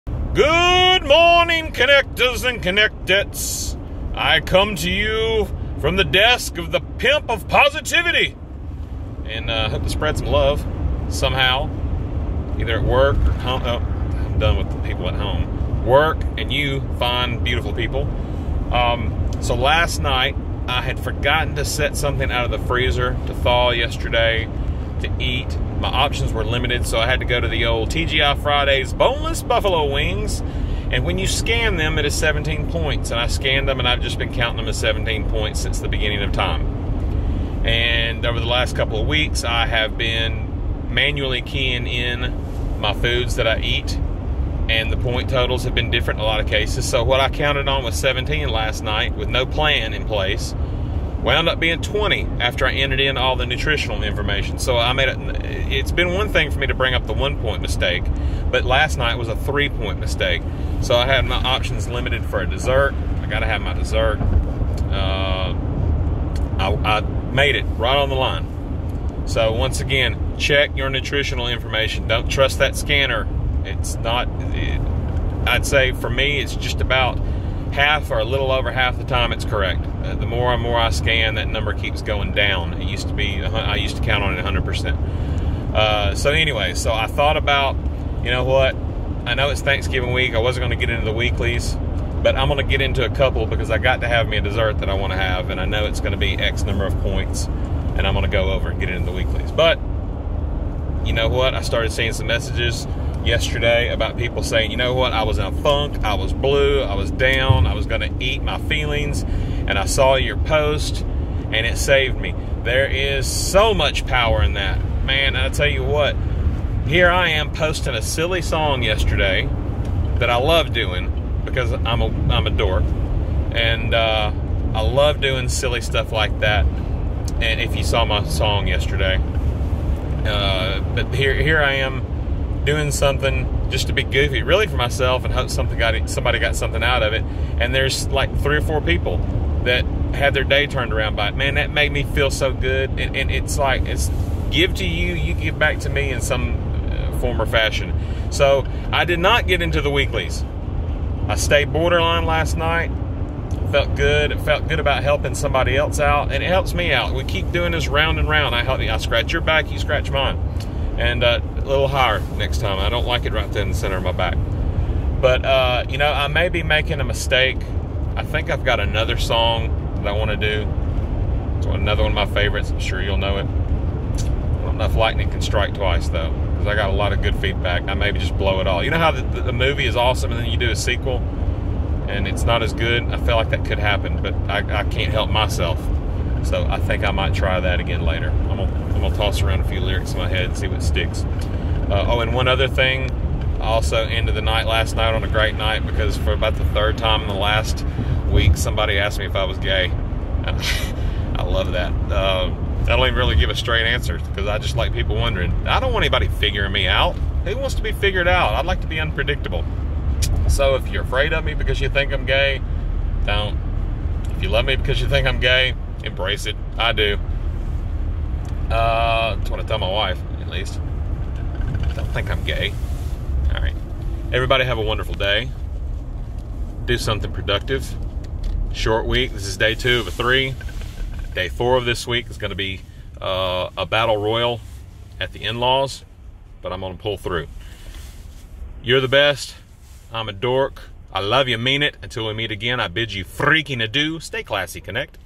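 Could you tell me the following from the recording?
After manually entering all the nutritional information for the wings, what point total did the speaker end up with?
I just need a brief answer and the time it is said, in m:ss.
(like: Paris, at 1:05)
20, at 0:51.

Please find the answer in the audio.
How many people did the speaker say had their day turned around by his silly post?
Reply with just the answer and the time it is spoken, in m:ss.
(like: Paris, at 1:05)
3 or 4, at 2:18.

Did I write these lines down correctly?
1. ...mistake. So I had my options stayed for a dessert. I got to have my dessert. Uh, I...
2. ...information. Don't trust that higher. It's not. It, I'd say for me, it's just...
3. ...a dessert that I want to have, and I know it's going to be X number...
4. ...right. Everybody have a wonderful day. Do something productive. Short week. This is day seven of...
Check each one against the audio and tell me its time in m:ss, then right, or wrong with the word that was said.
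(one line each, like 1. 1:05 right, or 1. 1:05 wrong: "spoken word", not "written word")
1. 0:59 wrong: "limited", not "stayed"
2. 1:11 wrong: "scanner", not "higher"
3. 1:34 right
4. 3:43 wrong: "two", not "seven".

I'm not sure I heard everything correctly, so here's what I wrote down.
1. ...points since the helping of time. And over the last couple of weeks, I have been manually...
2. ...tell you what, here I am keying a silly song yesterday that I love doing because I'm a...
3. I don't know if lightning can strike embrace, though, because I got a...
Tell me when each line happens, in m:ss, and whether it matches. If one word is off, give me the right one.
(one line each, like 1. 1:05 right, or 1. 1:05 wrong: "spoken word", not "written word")
1. 0:35 wrong: "beginning", not "helping"
2. 1:55 wrong: "posting", not "keying"
3. 2:54 wrong: "twice", not "embrace".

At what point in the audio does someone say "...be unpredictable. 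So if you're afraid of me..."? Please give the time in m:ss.
3:28.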